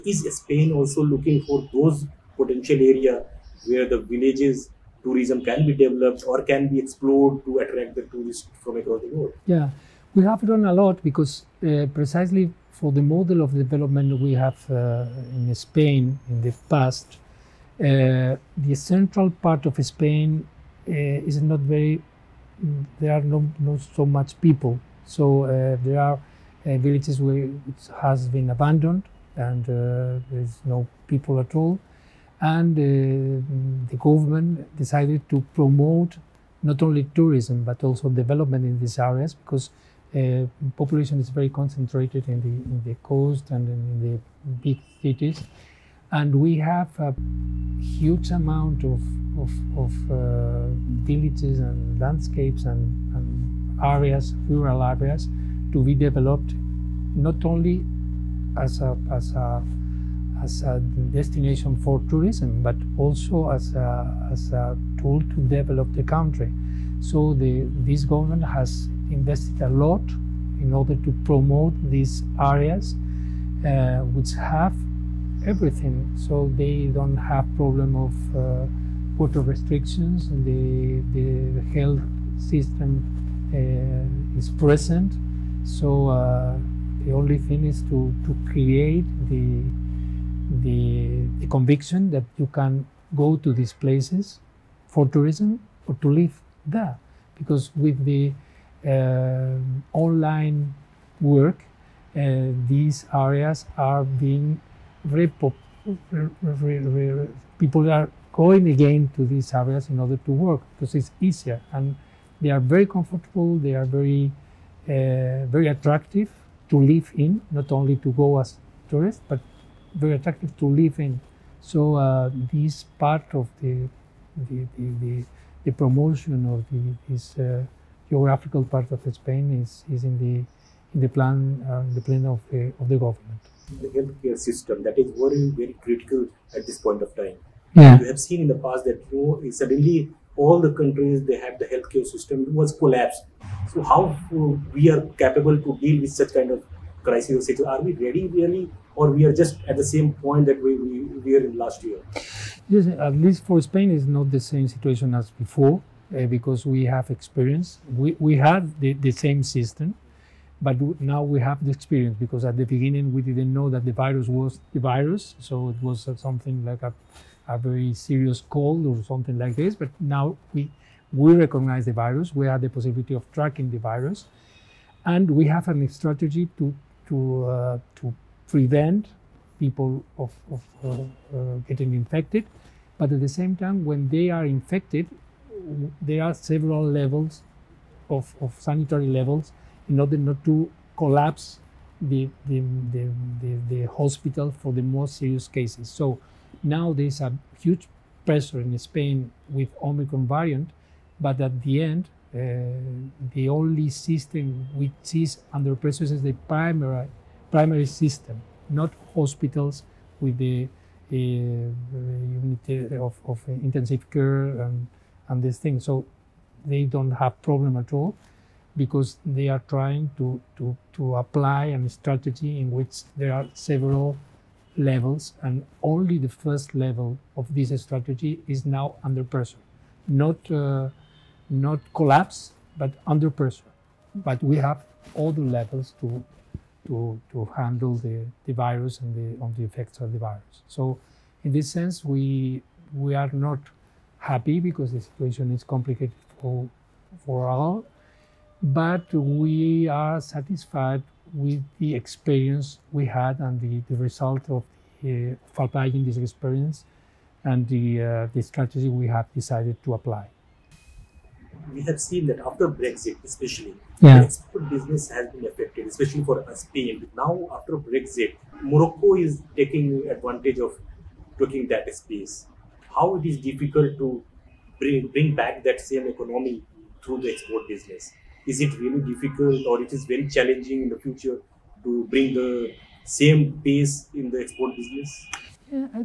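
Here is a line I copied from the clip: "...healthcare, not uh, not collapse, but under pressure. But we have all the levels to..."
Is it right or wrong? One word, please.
wrong.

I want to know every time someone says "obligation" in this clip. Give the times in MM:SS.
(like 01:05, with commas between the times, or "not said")
not said.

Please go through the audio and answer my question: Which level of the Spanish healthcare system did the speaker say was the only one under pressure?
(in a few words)
Primary system.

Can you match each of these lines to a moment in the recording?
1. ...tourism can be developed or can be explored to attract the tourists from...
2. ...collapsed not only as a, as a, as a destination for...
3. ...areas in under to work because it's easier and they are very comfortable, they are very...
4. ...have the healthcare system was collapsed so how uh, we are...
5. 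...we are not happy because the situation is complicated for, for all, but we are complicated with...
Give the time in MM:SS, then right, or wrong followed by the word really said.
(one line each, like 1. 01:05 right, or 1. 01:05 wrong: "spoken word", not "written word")
1. 00:05 right
2. 00:55 wrong: "developed", not "collapsed"
3. 01:49 wrong: "order", not "under"
4. 02:21 right
5. 04:02 wrong: "satisfied", not "complicated".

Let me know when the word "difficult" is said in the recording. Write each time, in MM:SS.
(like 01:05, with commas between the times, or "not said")
04:33, 04:39.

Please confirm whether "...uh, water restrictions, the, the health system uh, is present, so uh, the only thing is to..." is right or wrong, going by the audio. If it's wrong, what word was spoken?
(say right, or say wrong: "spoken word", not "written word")
right.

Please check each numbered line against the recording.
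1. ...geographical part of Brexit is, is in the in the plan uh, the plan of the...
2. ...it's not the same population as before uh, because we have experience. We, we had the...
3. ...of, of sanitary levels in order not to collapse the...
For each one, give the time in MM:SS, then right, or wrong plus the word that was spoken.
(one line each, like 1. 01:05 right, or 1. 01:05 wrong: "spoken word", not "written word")
1. 02:08 wrong: "Spain", not "Brexit"
2. 02:33 wrong: "situation", not "population"
3. 03:08 right.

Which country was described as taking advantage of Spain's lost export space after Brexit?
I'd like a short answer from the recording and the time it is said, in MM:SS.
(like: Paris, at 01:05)
Morocco, at 04:28.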